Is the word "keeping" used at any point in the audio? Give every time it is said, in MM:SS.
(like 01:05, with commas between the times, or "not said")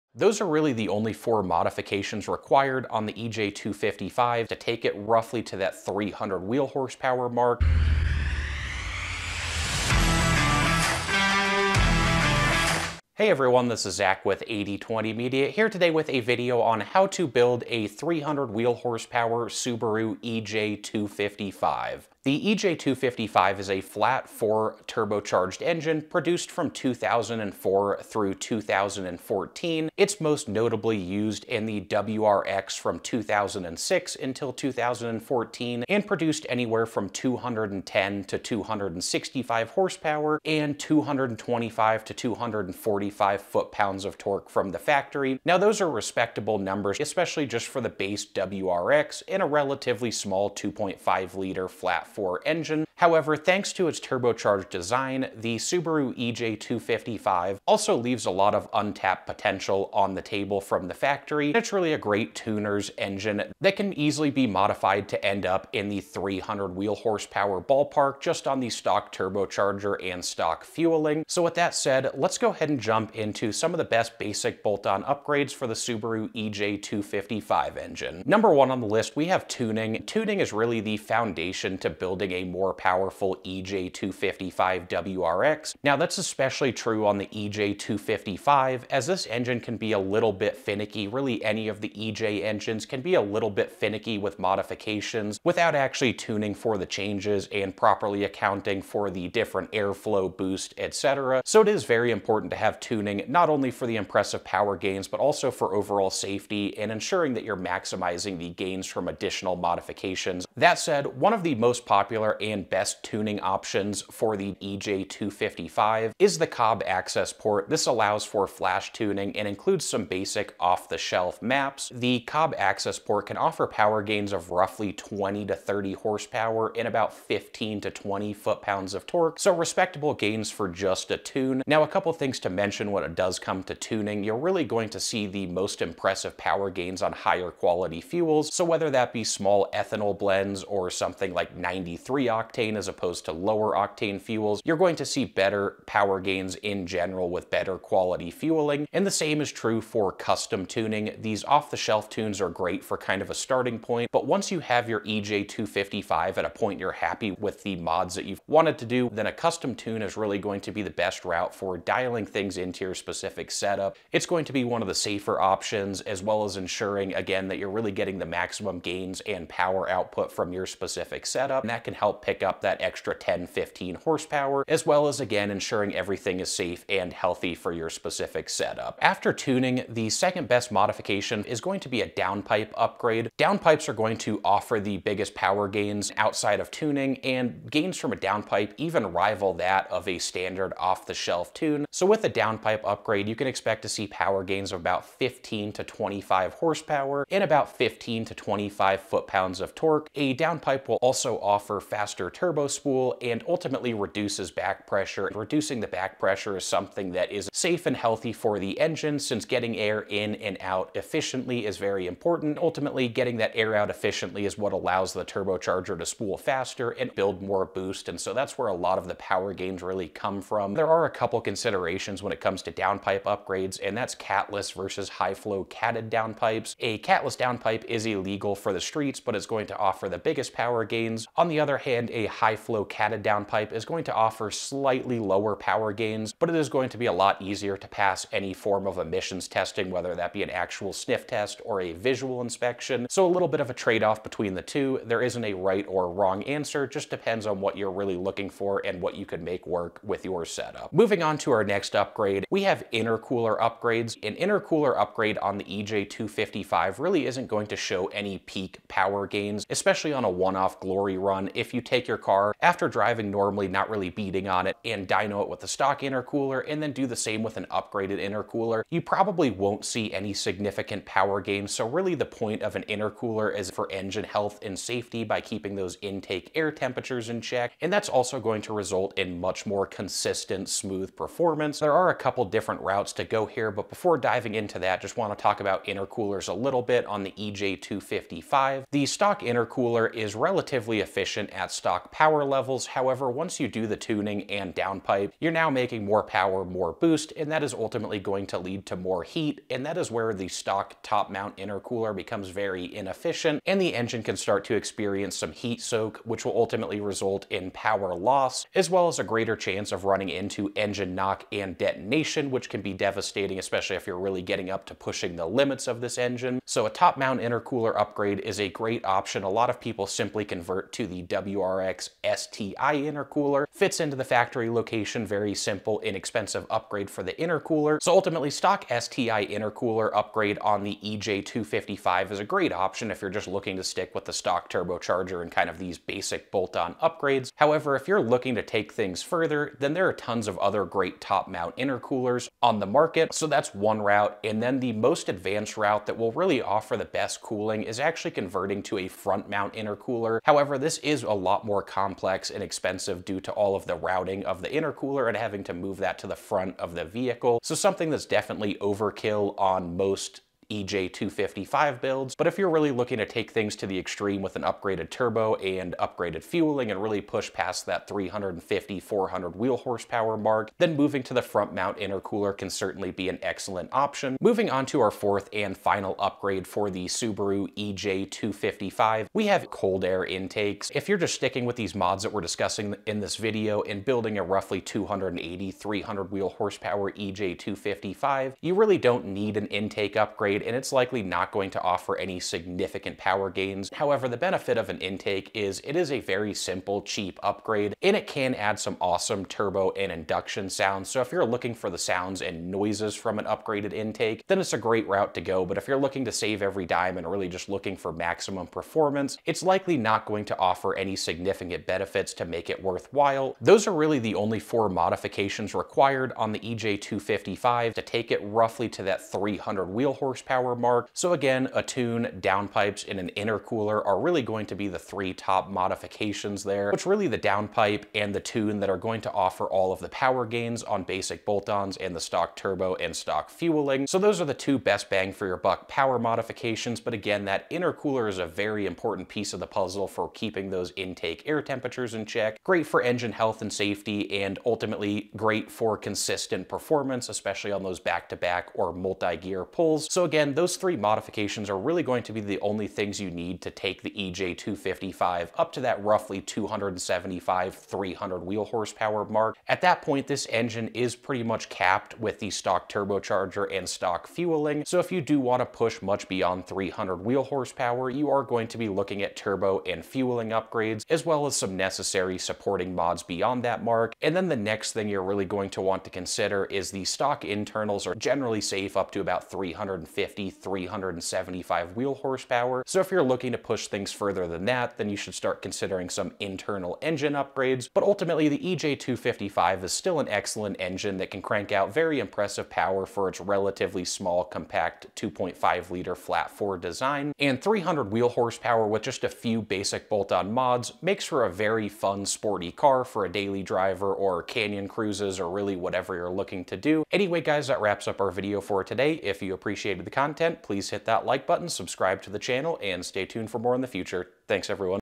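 04:35, 07:20.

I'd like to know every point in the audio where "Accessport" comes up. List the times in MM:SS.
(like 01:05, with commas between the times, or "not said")
01:56, 02:02.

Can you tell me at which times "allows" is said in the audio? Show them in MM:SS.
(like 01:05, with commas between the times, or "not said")
01:57, 03:34.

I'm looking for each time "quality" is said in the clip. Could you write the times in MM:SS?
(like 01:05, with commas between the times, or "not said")
02:17, 02:27.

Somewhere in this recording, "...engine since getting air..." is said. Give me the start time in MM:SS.
03:28.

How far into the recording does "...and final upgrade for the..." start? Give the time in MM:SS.
06:15.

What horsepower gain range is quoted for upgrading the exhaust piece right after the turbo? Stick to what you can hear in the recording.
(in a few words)
15 to 25 horsepower.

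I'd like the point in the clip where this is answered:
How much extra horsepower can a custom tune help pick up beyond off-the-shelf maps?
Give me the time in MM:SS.
02:53.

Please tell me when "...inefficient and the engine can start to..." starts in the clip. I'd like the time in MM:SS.
05:02.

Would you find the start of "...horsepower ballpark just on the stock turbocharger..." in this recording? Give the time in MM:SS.
01:06.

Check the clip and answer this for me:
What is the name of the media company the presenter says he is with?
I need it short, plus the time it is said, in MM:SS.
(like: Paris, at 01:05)
8020 Media, at 00:14.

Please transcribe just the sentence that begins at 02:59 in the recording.
After tuning, the second best modification is going to be a downpipe upgrade.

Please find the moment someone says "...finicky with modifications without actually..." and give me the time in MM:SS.
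01:33.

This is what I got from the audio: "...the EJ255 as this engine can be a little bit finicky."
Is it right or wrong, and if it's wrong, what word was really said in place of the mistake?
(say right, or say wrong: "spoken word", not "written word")
right.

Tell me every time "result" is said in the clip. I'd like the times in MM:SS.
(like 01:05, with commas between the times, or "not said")
04:38, 05:06.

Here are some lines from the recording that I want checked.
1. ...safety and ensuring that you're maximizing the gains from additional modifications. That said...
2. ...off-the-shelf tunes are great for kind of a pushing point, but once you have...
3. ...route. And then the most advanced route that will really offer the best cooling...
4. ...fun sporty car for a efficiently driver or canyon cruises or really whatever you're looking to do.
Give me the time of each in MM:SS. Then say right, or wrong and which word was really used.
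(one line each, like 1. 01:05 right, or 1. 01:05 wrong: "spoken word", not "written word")
1. 01:46 right
2. 02:31 wrong: "starting", not "pushing"
3. 05:44 right
4. 08:21 wrong: "daily", not "efficiently".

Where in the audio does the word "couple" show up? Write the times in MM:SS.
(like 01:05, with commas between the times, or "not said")
02:11, 03:41, 04:42.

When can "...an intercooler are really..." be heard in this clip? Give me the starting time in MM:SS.
07:03.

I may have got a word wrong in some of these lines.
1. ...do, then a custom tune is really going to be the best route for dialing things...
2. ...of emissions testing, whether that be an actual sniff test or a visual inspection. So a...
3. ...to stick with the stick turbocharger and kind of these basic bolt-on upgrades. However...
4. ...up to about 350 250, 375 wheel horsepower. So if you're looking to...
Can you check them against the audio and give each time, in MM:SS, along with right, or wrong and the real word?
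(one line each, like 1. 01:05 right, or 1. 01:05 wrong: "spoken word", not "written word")
1. 02:38 right
2. 03:58 right
3. 05:33 wrong: "stock", not "stick"
4. 07:58 right.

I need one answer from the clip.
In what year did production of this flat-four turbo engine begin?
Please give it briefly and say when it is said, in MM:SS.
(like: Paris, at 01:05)
2004, at 00:26.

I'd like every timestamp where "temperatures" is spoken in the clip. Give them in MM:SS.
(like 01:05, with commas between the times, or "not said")
04:36, 07:21.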